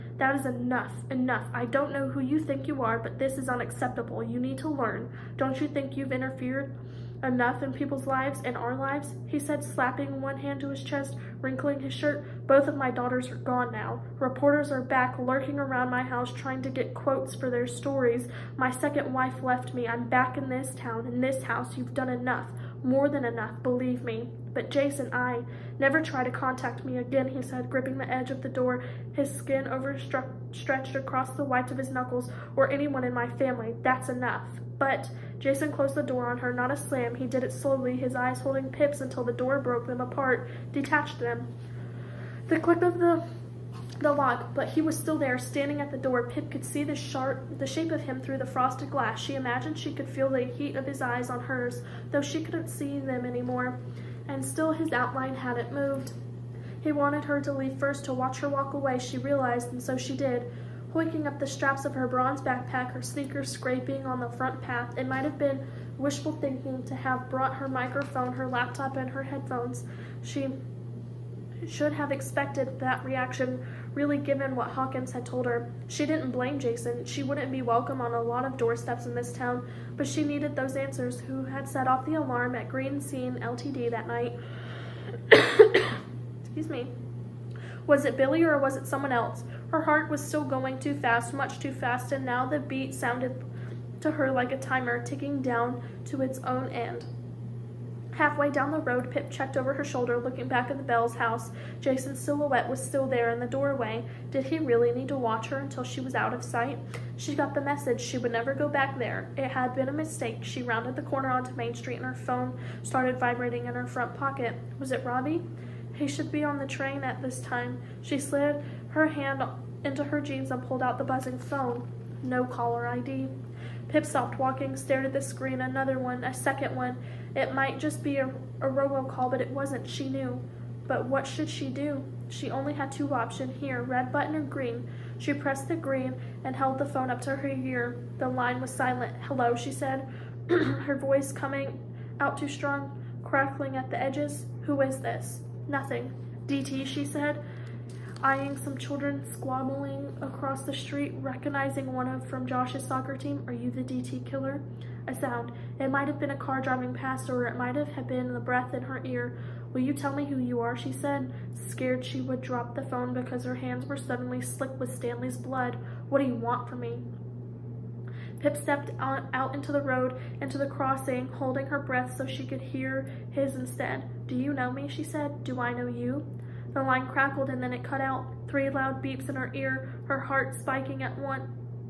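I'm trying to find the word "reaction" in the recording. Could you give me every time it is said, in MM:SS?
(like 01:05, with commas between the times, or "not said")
01:13.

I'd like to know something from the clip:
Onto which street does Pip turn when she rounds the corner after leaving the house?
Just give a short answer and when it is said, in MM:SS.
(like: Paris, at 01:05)
Main Street, at 01:51.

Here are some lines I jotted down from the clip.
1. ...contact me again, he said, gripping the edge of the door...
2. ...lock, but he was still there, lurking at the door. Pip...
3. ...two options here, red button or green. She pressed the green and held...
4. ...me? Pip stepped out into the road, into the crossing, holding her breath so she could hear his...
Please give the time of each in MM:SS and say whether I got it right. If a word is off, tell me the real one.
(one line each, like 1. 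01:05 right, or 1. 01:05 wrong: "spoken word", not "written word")
1. 00:26 right
2. 00:44 wrong: "standing", not "lurking"
3. 02:12 right
4. 02:46 right.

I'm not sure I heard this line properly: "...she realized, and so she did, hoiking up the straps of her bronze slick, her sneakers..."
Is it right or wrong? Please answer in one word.
wrong.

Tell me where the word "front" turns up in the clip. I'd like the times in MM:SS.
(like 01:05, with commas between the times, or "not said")
01:04, 01:53.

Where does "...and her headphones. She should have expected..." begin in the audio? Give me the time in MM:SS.
01:08.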